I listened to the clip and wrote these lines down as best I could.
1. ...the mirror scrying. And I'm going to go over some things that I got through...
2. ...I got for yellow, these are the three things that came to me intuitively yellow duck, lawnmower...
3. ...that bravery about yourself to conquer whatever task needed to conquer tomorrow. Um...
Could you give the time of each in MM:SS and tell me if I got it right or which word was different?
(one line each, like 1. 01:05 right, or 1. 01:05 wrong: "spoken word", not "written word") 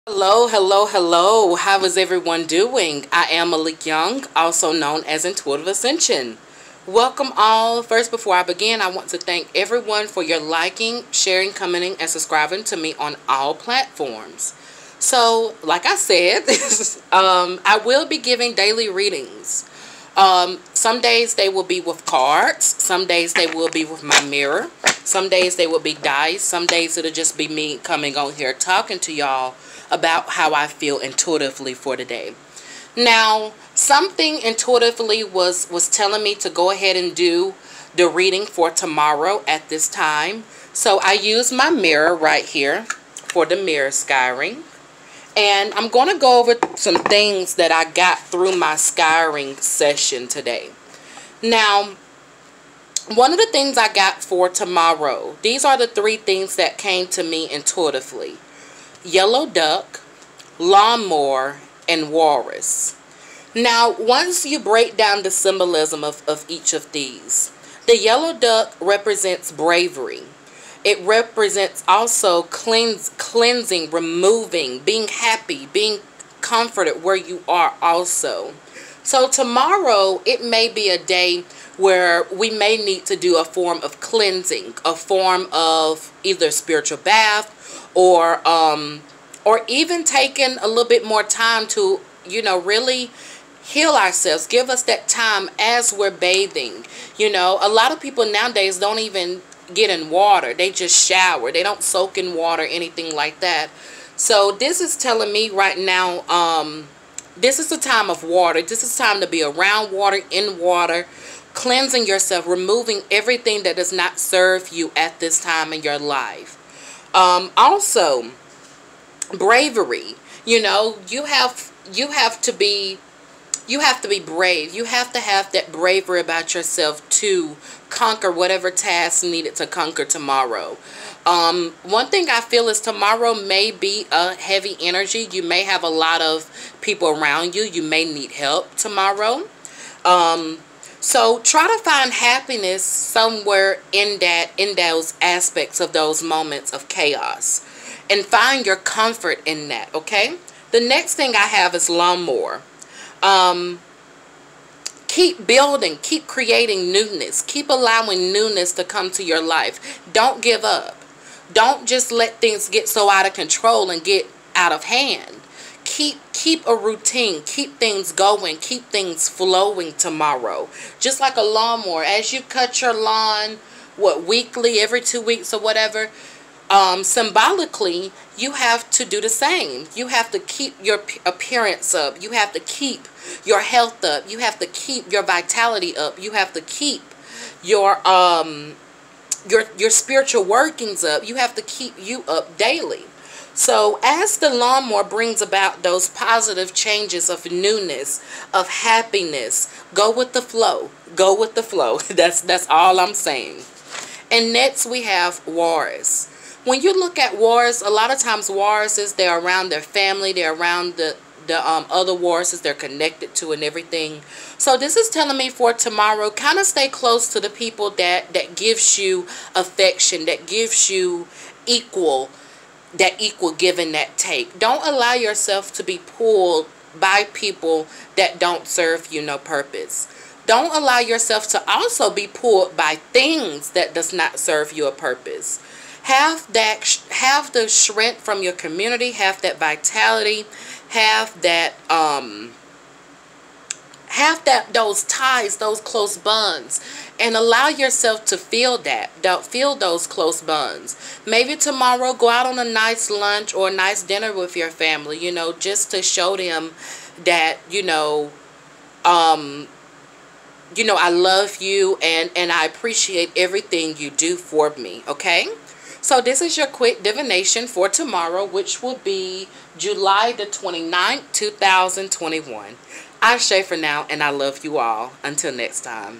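1. 00:43 right
2. 00:53 wrong: "tomorrow", not "yellow"
3. 02:05 right.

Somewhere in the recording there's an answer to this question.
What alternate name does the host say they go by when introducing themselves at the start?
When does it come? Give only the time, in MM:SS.
00:05.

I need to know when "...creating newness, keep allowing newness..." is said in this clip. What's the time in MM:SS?
02:36.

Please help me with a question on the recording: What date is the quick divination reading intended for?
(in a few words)
July 29, 2021.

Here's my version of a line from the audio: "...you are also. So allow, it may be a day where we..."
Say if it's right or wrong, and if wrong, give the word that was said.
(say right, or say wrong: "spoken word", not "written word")
wrong: "tomorrow", not "allow".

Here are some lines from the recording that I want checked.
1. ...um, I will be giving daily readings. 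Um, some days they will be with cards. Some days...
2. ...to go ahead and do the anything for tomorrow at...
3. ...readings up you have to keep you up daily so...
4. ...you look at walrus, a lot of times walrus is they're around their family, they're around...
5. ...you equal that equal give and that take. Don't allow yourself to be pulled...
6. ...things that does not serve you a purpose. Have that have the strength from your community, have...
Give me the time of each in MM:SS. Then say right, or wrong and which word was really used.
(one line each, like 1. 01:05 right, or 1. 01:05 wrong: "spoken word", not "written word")
1. 00:17 right
2. 00:36 wrong: "reading", not "anything"
3. 03:10 wrong: "workings", not "readings"
4. 03:26 right
5. 03:40 right
6. 03:53 right.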